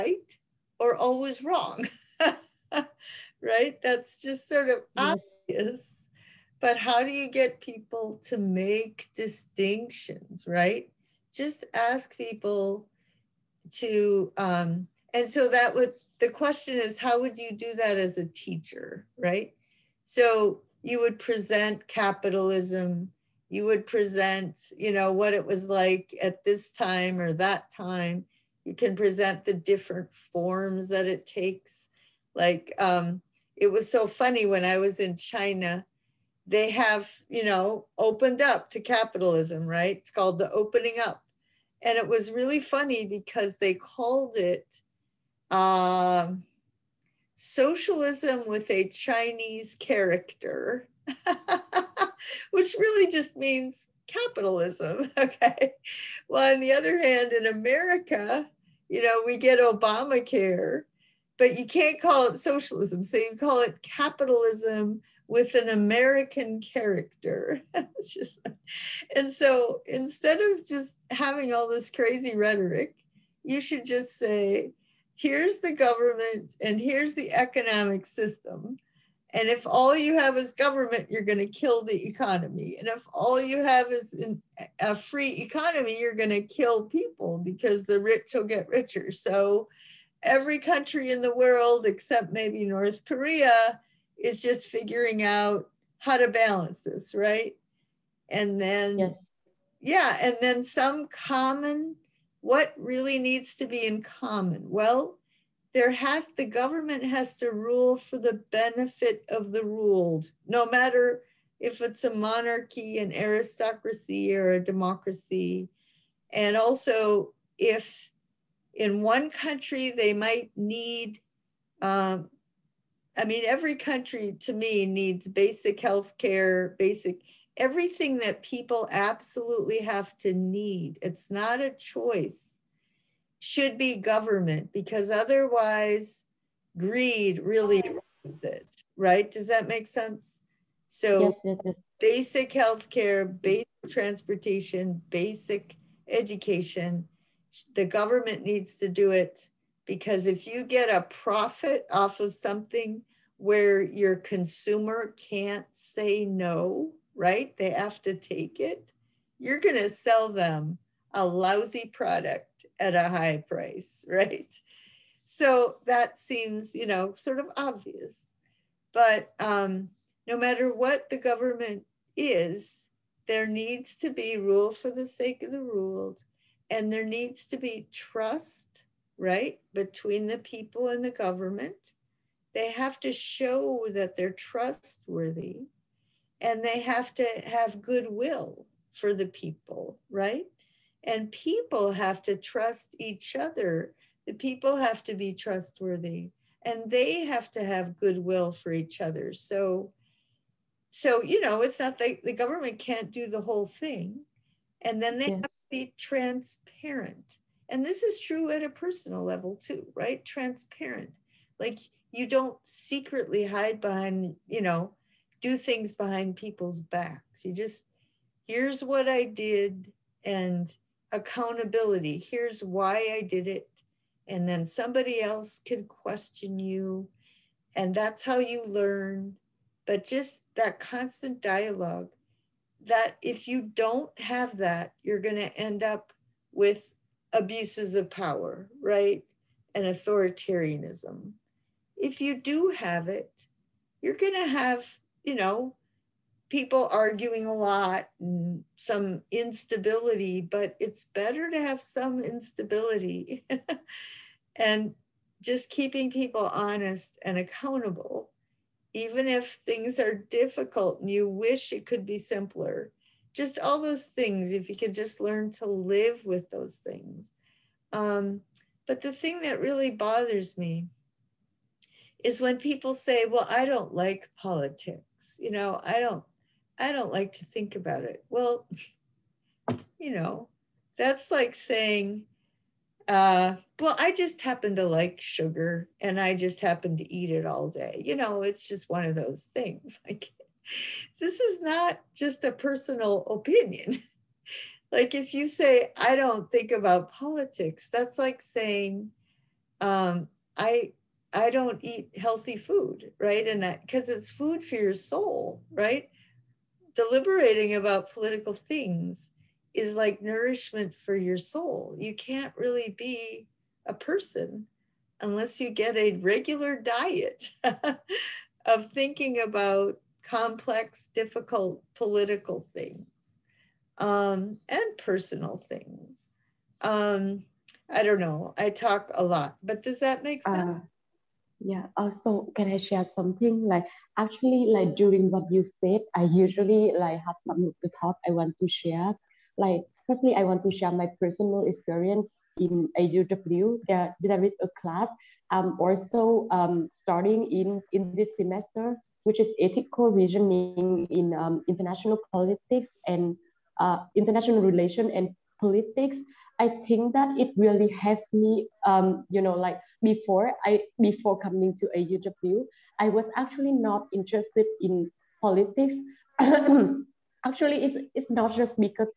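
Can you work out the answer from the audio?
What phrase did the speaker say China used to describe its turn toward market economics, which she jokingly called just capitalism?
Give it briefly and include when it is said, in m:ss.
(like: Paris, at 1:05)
socialism with a Chinese character, at 0:47.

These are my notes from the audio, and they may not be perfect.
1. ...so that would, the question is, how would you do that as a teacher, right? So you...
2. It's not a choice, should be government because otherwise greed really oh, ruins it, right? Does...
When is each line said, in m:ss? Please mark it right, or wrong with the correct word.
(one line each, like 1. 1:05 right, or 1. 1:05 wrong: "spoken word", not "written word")
1. 0:15 right
2. 2:11 right.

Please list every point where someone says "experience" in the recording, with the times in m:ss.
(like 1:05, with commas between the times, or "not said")
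5:41.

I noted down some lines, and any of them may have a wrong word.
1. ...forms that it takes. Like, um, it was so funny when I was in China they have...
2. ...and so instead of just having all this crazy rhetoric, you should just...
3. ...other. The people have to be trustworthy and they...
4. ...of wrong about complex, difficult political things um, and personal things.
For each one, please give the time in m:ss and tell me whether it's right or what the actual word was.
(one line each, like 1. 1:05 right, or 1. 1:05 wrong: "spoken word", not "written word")
1. 0:30 right
2. 1:09 right
3. 3:13 right
4. 5:18 wrong: "thinking", not "wrong".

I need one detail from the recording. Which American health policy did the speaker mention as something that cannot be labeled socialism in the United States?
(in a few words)
Obamacare.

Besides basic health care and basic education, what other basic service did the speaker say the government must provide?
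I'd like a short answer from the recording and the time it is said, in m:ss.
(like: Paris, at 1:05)
basic transportation, at 2:23.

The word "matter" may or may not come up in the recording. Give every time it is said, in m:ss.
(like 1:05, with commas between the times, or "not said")
1:50, 2:50.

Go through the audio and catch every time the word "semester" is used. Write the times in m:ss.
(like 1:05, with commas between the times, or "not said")
5:48.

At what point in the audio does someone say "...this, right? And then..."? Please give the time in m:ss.
1:36.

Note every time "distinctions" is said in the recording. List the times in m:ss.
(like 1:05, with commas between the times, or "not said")
0:09.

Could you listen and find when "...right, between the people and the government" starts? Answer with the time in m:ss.
2:59.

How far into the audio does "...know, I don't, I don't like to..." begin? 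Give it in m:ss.
4:35.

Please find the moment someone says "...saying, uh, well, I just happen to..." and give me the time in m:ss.
4:41.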